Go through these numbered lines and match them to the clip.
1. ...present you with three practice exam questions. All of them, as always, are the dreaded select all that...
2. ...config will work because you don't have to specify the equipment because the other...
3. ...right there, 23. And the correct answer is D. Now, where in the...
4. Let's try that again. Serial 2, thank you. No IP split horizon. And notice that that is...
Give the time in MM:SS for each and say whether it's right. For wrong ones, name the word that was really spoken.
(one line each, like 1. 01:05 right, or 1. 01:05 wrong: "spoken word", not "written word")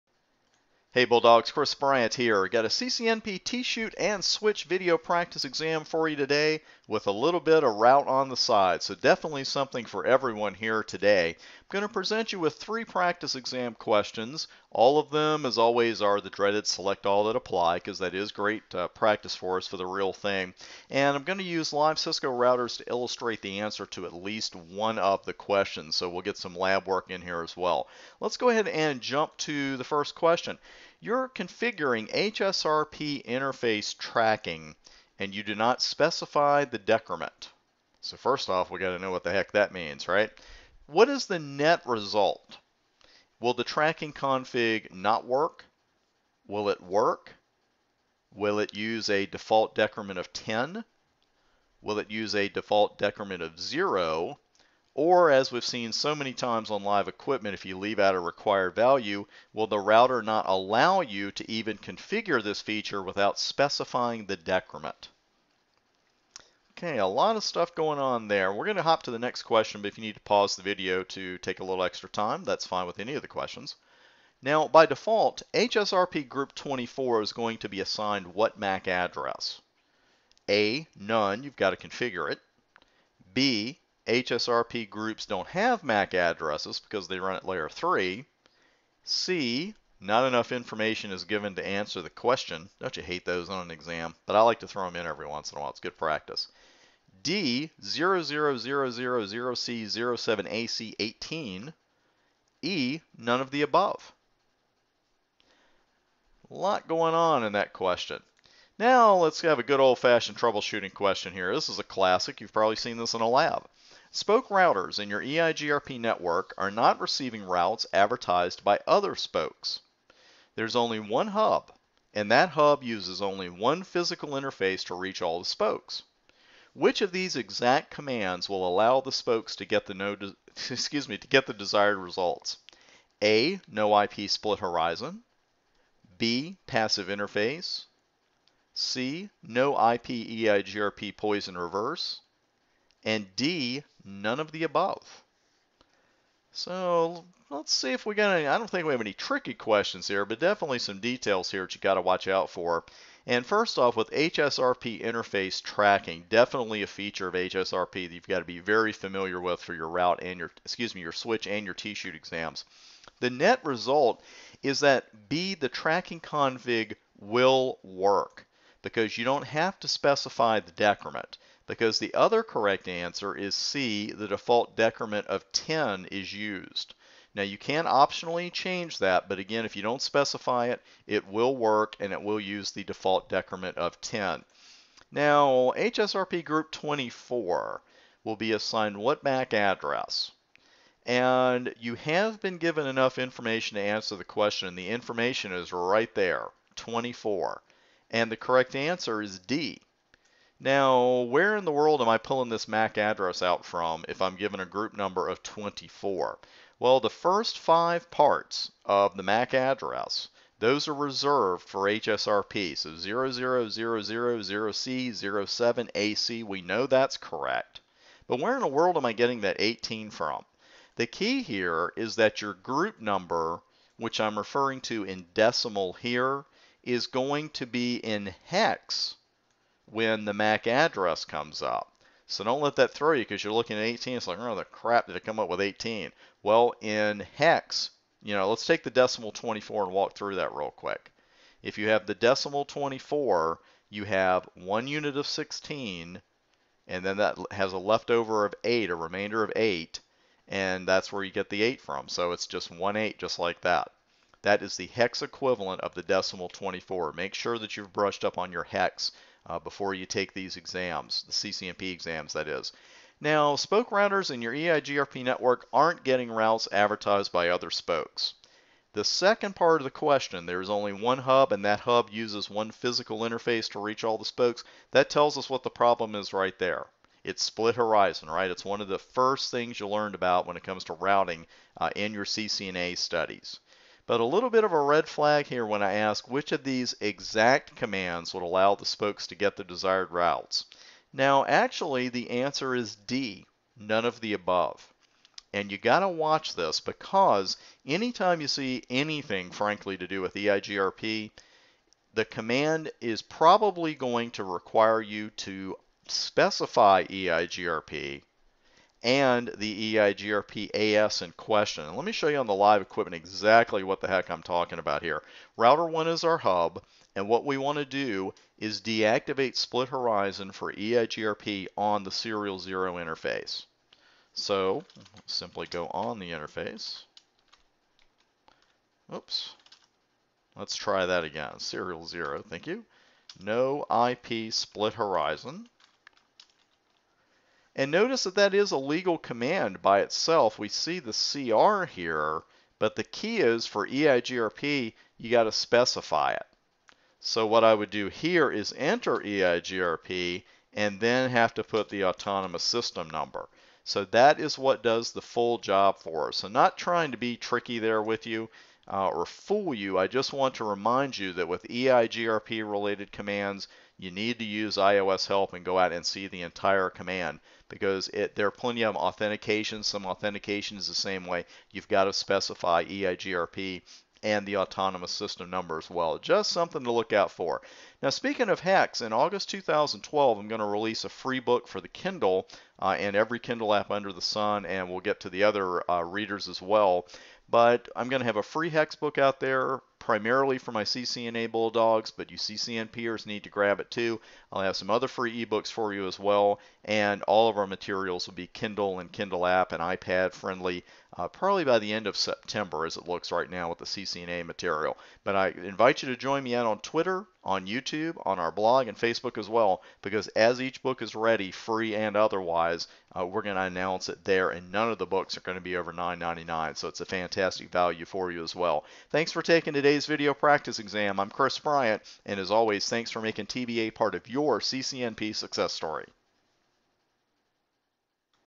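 1. 00:11 right
2. 02:46 wrong: "decrement", not "equipment"
3. 03:15 wrong: "24", not "23"
4. 05:30 wrong: "0", not "2".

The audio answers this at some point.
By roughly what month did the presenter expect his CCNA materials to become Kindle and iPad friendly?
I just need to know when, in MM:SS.
06:41.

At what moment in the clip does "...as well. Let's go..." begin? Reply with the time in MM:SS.
00:27.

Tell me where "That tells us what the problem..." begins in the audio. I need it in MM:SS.
04:34.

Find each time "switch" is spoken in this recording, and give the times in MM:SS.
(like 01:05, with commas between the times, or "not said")
00:04, 02:41.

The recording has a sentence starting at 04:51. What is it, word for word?
Now, actually, the answer is D, none of the above.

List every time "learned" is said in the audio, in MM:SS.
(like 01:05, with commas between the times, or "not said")
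04:39.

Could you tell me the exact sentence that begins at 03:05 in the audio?
Now, HSRP group 24 will be assigned what MAC address?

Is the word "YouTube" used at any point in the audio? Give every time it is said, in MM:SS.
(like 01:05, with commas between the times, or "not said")
06:47.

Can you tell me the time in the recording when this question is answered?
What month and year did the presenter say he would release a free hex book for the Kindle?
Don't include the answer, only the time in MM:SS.
06:19.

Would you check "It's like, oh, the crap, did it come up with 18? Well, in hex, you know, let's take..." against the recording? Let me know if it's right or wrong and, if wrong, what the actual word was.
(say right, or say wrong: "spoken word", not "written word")
right.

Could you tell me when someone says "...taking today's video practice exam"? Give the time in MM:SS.
06:59.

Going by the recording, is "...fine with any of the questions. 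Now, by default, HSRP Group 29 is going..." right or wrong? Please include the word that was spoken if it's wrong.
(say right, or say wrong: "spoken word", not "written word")
wrong: "24", not "29".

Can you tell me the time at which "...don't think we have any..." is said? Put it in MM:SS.
02:28.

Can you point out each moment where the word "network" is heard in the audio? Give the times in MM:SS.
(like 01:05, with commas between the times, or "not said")
01:55, 04:25.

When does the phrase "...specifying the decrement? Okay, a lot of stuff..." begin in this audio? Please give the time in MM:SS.
01:03.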